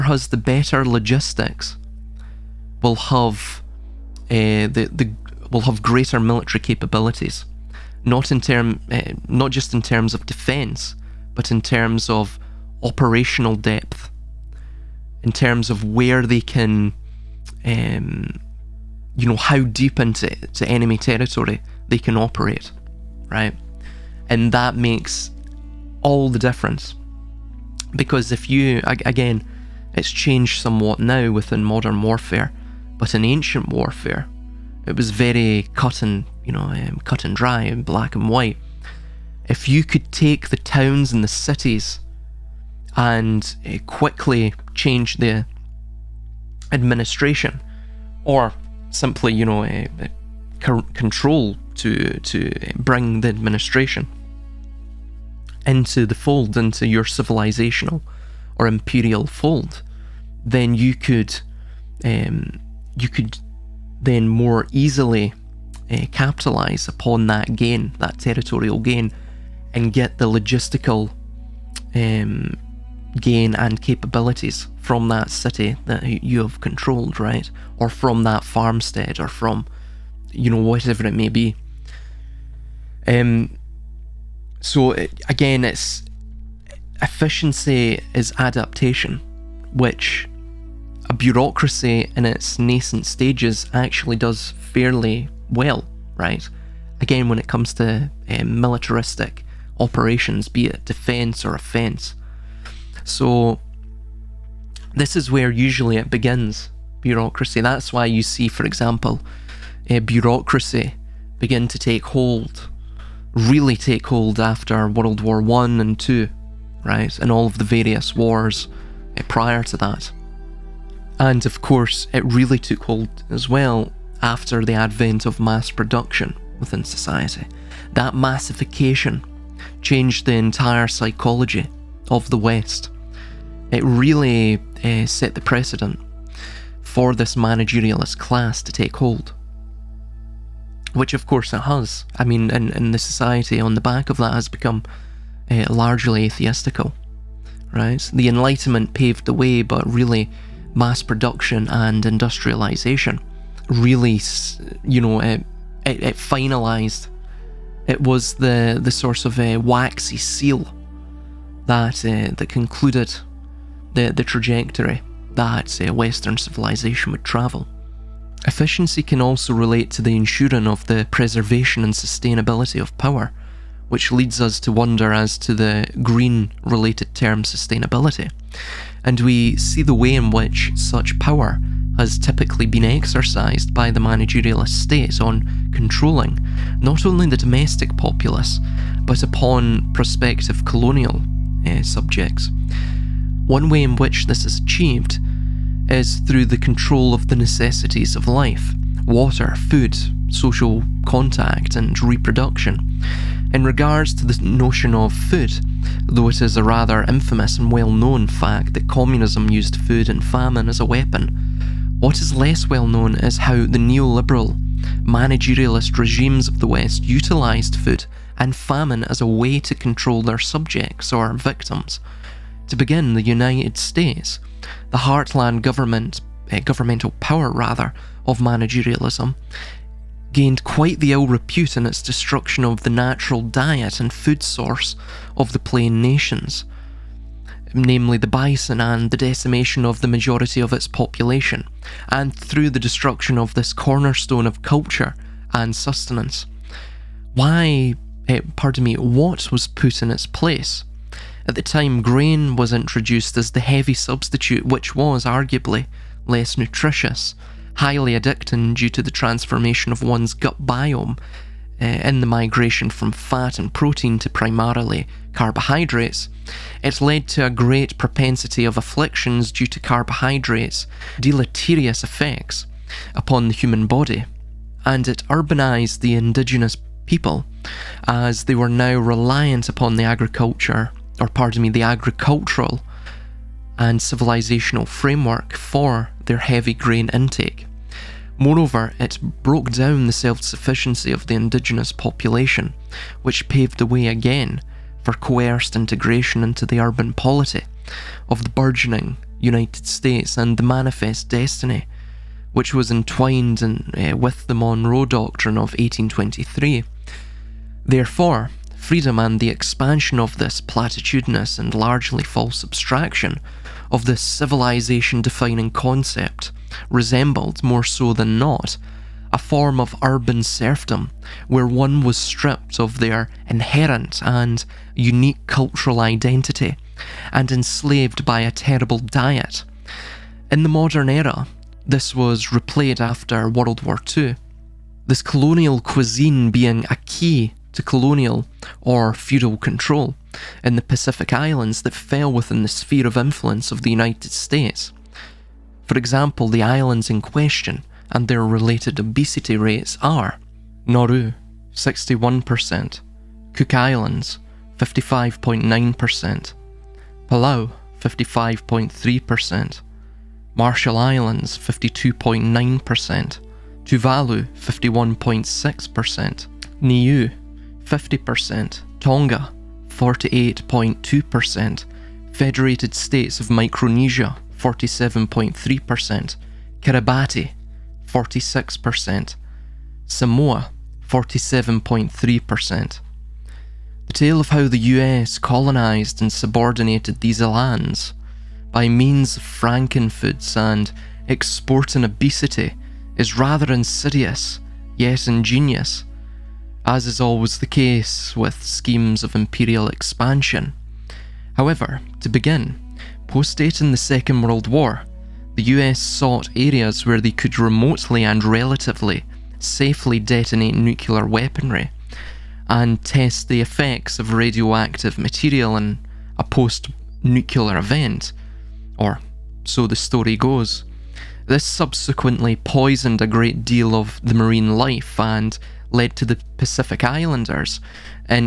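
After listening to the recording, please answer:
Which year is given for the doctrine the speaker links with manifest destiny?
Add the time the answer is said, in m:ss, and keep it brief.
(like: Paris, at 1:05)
1823, at 5:05.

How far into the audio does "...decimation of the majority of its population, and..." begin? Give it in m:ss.
3:59.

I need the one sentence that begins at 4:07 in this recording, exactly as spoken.
Why, eh, pardon me, what was put in its place?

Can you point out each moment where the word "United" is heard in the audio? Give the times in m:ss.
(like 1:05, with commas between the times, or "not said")
3:43, 4:59, 5:43.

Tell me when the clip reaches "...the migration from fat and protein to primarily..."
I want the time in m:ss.
4:22.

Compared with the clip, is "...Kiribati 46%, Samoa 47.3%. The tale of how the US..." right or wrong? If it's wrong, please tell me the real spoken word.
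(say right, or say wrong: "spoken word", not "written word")
right.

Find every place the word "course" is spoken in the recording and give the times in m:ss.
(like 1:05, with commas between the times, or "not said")
2:01, 2:21.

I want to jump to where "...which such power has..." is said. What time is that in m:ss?
3:00.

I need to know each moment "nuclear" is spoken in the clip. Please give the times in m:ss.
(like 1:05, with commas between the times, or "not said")
6:50, 6:57.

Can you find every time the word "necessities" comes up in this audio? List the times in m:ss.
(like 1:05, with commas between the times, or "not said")
3:17.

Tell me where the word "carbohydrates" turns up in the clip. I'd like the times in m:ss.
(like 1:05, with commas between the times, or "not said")
4:25, 4:29.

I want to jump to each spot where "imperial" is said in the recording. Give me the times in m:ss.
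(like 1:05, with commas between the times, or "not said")
0:58, 6:39.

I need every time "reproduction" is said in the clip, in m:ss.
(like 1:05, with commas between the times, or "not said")
3:22.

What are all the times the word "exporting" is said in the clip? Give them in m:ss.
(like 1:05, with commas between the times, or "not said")
6:31.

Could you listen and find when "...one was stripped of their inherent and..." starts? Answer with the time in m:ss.
5:21.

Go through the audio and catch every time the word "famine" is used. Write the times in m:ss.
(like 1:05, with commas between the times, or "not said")
3:30, 3:38.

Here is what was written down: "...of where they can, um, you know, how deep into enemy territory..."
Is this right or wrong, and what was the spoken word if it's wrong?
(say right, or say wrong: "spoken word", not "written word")
right.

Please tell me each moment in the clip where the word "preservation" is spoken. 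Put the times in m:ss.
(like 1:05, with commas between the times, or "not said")
2:51.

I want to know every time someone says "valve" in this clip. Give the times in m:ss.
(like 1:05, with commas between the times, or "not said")
not said.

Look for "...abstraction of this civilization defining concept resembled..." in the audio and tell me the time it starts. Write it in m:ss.
5:12.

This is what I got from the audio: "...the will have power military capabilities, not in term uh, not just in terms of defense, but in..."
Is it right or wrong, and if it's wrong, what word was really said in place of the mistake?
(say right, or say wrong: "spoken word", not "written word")
wrong: "greater", not "power".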